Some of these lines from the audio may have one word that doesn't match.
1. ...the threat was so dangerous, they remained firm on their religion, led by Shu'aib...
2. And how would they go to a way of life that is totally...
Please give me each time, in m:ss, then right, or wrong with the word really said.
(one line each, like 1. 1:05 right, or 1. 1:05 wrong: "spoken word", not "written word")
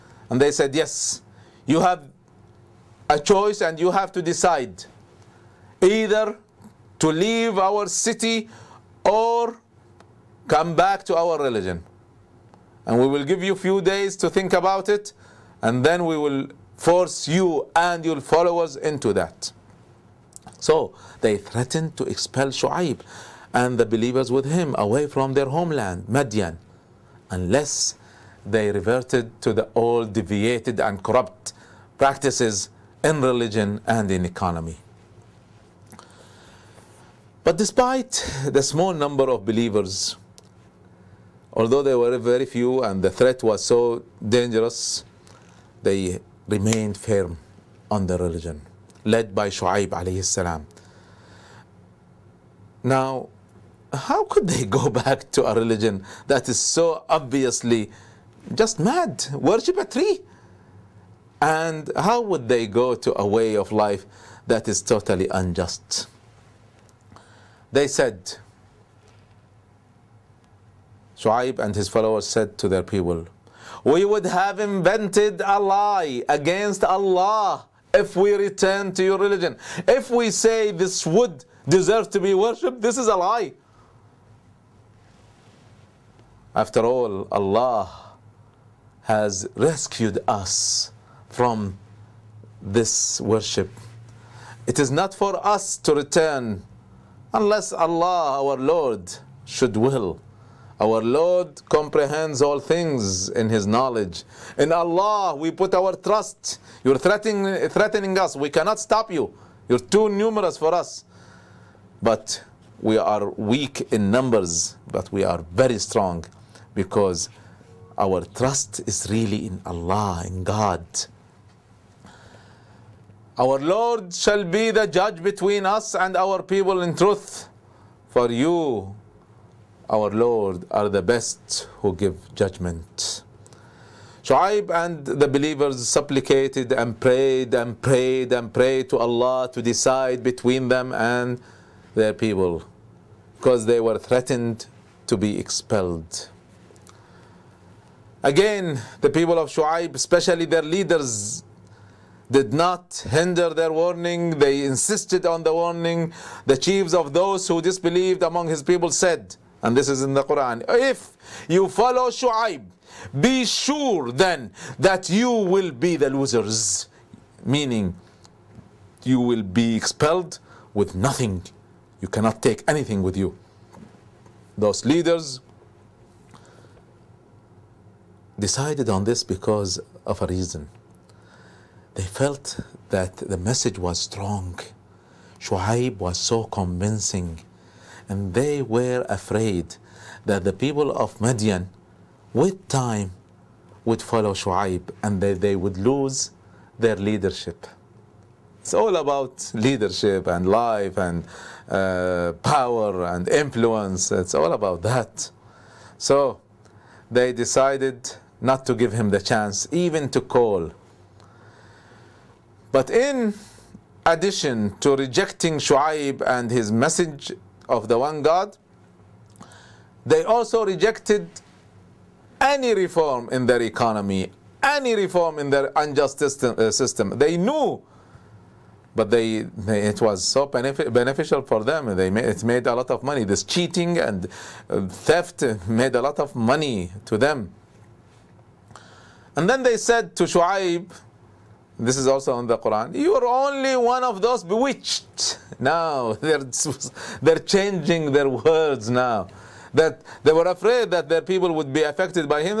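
1. 0:43 right
2. 1:01 right.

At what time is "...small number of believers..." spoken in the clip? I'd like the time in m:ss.
0:38.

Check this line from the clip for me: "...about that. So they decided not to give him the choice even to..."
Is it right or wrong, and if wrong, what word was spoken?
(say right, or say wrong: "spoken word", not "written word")
wrong: "chance", not "choice".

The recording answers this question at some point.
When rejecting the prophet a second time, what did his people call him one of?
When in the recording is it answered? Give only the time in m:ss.
4:04.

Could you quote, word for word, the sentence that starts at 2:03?
Our Lord shall be the judge between us and our people in truth.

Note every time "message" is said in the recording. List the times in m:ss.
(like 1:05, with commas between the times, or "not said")
3:03, 3:36.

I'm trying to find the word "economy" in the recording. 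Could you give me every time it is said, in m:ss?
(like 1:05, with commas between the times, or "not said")
0:34, 3:43.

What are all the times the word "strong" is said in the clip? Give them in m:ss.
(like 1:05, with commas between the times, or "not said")
1:55, 3:03.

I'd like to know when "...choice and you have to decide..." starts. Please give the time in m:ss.
0:03.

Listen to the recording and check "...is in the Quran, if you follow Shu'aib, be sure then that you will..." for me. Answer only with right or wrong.
right.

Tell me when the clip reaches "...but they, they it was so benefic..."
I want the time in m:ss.
3:48.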